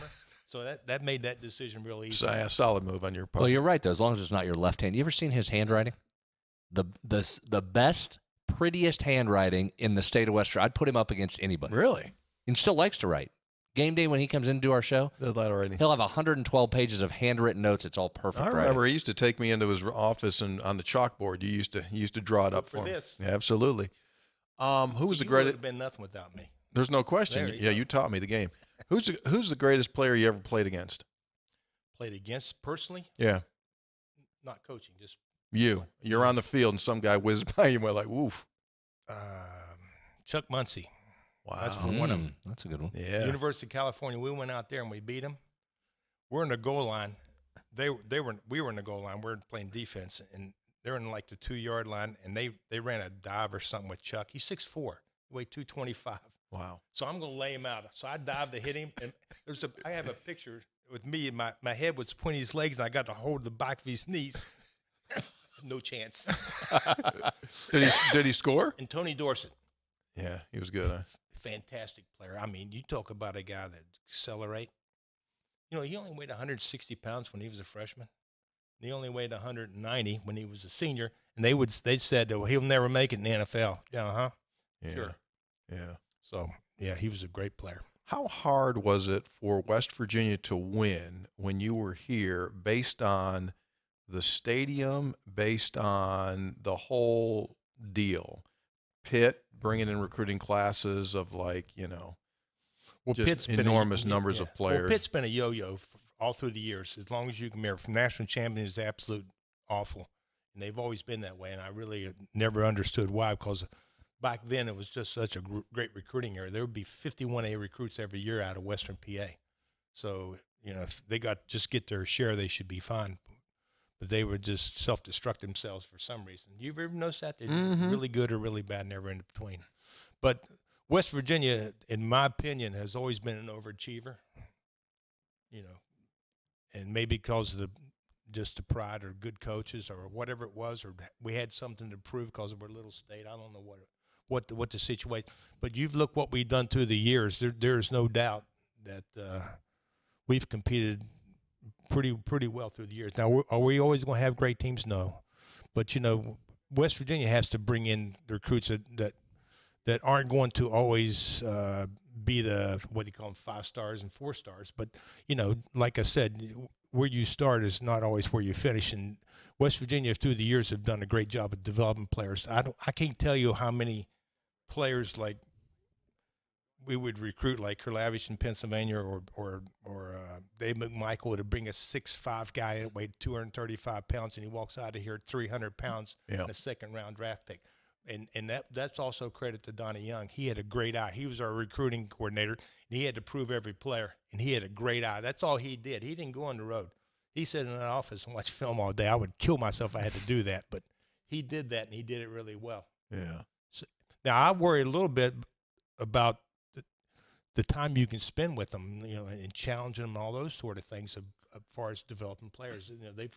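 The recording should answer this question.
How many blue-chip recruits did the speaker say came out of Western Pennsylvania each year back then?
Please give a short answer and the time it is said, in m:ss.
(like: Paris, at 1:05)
51, at 1:56.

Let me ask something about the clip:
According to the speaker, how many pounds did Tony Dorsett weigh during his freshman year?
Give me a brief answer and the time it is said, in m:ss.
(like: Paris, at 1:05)
160, at 1:16.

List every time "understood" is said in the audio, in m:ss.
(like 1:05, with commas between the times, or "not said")
1:52.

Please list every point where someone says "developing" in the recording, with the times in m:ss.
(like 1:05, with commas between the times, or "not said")
2:51, 3:32.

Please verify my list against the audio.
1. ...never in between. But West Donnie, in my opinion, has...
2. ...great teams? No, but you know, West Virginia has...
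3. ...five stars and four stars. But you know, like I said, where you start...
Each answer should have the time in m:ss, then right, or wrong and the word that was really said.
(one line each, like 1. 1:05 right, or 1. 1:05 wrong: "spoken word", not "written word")
1. 2:08 wrong: "Virginia", not "Donnie"
2. 2:34 right
3. 2:43 right.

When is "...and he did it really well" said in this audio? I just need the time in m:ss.
3:21.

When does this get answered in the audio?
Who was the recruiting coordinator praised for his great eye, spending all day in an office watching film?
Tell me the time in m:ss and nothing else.
3:09.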